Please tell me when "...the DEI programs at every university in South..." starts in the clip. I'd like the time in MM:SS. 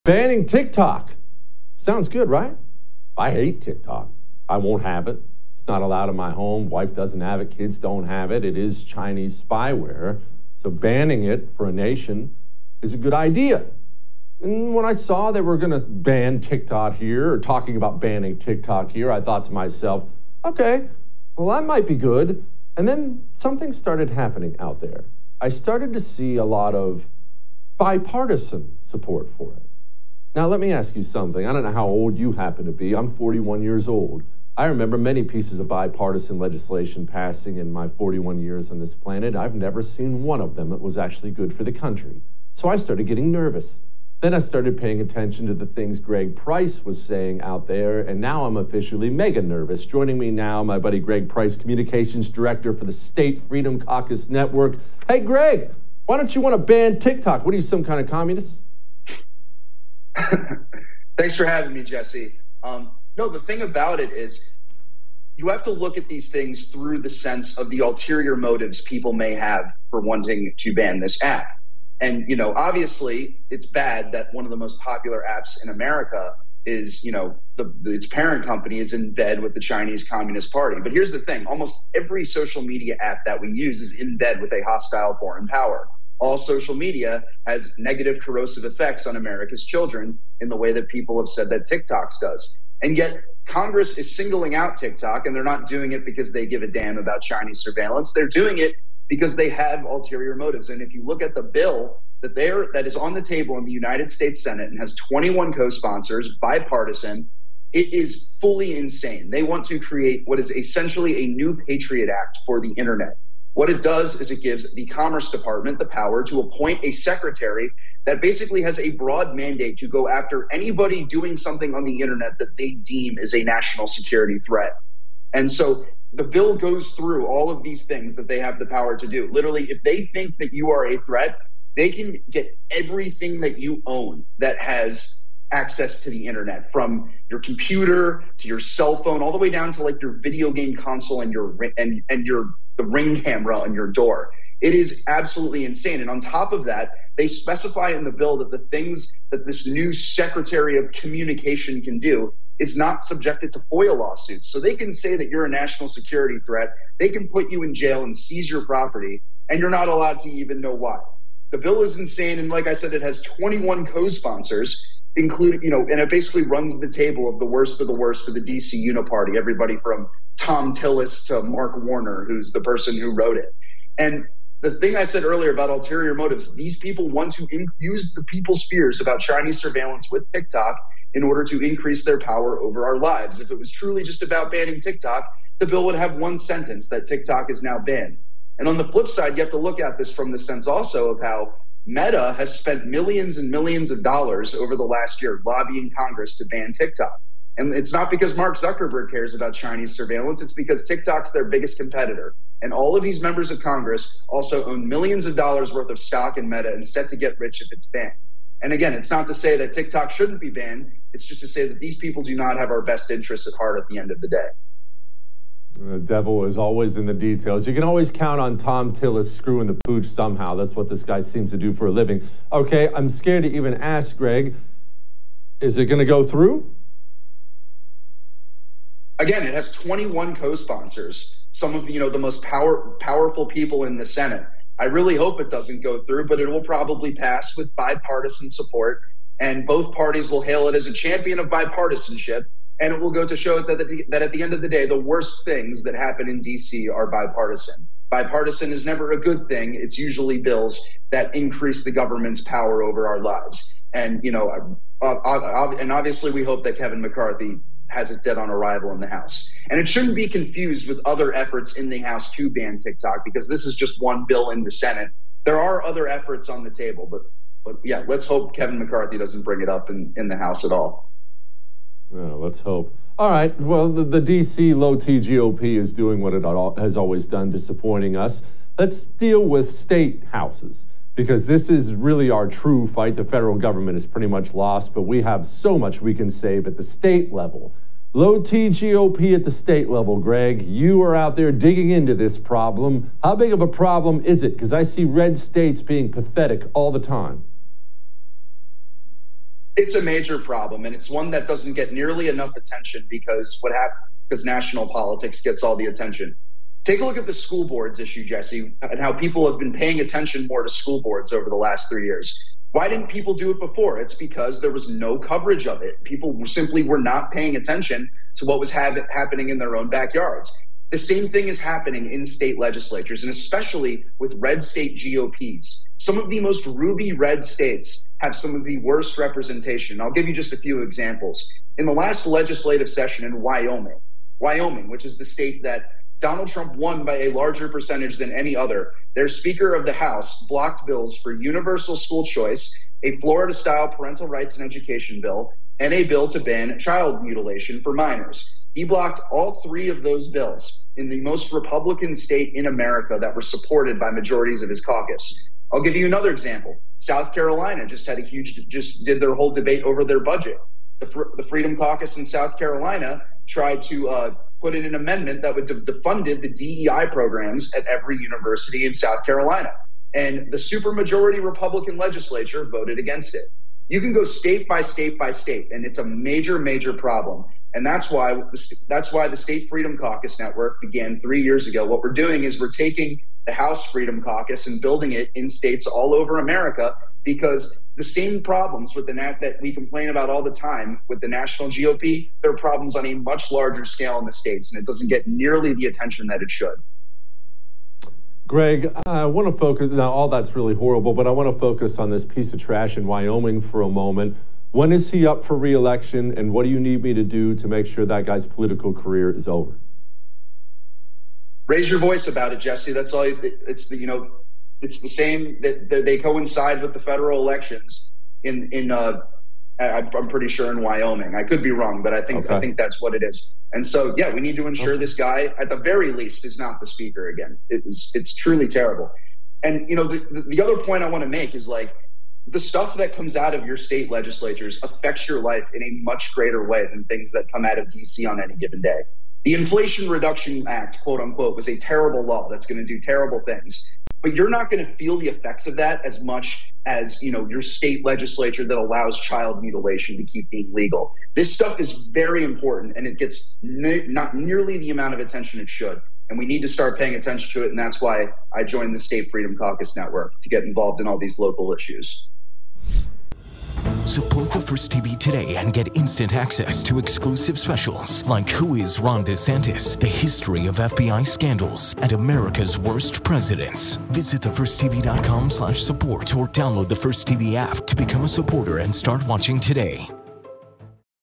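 06:06.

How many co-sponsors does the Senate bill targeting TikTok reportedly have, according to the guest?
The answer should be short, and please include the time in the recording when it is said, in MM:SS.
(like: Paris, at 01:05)
21, at 01:44.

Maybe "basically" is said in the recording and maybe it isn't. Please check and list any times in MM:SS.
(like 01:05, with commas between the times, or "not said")
01:58, 02:46.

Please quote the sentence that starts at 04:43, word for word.
The federal government is pretty much lost, but we have so much we can save at the state level.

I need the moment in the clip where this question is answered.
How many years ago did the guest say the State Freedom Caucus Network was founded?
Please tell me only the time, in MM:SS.
06:21.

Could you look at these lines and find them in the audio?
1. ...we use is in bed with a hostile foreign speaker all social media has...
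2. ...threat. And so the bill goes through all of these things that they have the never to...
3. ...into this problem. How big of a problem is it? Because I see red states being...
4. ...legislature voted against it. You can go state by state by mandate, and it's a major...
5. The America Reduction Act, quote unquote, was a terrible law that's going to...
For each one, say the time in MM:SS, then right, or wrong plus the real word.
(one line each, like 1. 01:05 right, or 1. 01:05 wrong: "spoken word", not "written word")
1. 01:23 wrong: "power", not "speaker"
2. 02:04 wrong: "power", not "never"
3. 04:51 right
4. 06:11 wrong: "state", not "mandate"
5. 07:19 wrong: "Inflation", not "America".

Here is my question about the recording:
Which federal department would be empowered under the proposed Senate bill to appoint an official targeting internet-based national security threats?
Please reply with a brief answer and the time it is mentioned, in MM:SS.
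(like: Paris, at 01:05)
Commerce Department, at 01:54.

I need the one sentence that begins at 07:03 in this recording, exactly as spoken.
And so, yeah, we need to ensure okay.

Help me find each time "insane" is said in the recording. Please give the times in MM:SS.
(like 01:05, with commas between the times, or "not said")
01:48, 02:25, 02:41.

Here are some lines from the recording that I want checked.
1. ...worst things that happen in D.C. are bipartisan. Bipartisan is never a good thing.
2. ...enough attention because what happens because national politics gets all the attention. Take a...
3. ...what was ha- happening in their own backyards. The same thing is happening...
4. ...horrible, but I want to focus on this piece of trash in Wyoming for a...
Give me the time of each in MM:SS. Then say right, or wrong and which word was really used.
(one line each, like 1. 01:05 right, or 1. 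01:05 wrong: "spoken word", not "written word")
1. 04:04 right
2. 05:02 right
3. 05:18 right
4. 06:40 right.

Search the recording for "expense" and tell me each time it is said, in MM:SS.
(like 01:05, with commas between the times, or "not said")
not said.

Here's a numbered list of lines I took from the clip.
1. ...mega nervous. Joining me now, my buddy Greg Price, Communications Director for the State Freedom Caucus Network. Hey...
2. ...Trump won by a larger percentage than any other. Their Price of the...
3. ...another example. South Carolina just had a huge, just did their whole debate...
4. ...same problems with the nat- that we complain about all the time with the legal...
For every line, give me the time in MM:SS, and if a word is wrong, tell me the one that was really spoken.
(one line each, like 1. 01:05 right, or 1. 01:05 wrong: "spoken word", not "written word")
1. 00:49 right
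2. 05:36 wrong: "Speaker", not "Price"
3. 05:56 right
4. 06:28 wrong: "national", not "legal".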